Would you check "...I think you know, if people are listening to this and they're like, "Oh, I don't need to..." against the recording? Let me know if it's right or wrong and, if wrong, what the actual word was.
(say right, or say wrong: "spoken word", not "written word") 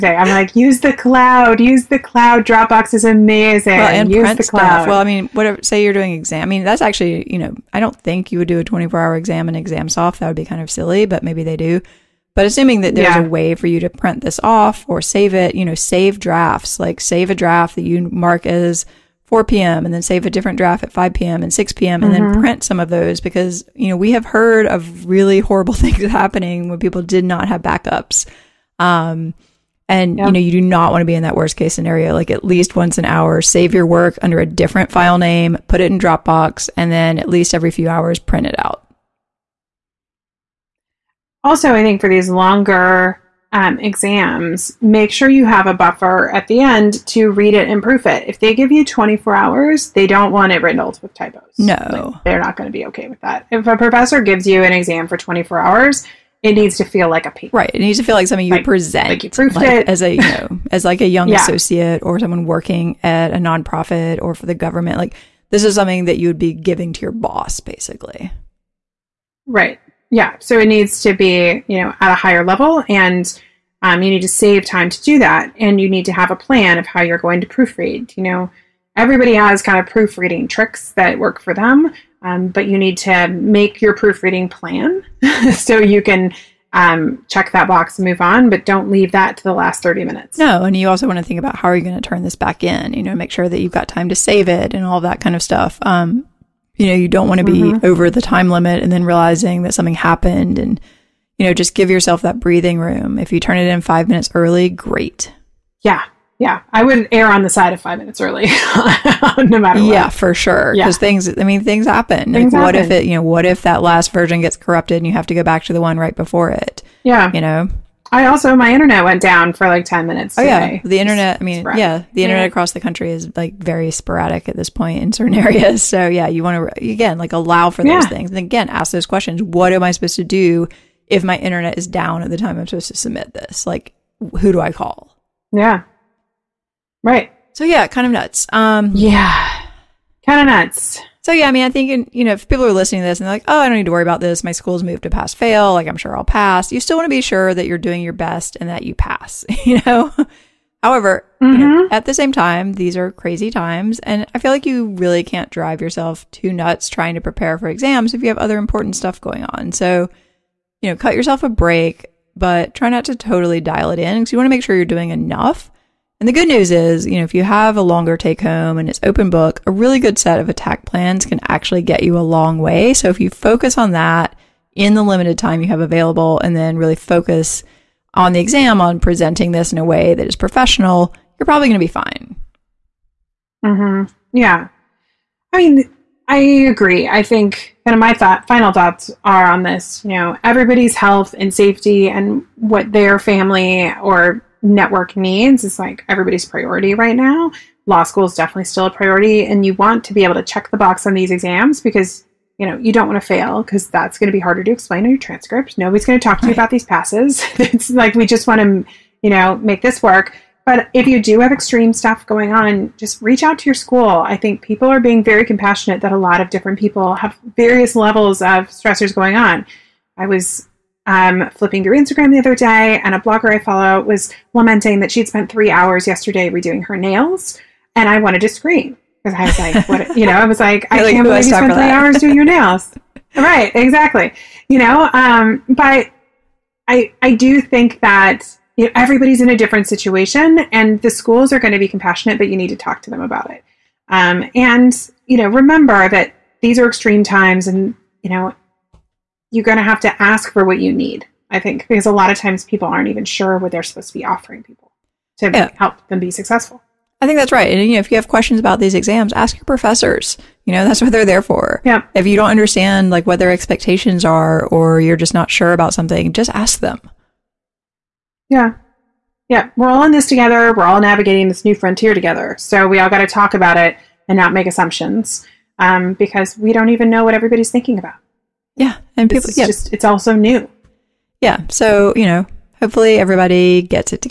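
right.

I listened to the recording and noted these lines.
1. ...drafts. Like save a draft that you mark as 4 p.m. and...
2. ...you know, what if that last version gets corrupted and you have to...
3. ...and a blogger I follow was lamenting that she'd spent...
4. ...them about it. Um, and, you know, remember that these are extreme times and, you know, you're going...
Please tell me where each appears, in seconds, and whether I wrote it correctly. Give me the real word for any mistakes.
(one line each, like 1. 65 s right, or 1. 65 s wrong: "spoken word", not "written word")
1. 16 s right
2. 113 s right
3. 223 s right
4. 243 s right.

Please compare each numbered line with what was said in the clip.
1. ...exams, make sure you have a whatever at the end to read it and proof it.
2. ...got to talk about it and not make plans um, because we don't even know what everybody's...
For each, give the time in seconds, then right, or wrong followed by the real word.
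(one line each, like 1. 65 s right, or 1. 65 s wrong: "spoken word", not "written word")
1. 43 s wrong: "buffer", not "whatever"
2. 273 s wrong: "assumptions", not "plans".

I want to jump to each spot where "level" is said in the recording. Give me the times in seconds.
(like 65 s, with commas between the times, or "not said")
72 s, 217 s.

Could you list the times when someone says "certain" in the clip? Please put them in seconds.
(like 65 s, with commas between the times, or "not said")
125 s.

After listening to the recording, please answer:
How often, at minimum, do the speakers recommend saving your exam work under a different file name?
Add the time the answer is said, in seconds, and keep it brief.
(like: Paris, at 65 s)
once an hour, at 32 s.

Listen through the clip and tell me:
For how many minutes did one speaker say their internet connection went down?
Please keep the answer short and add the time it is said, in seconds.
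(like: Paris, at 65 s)
10, at 119 s.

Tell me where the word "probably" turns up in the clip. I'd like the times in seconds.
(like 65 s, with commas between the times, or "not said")
181 s.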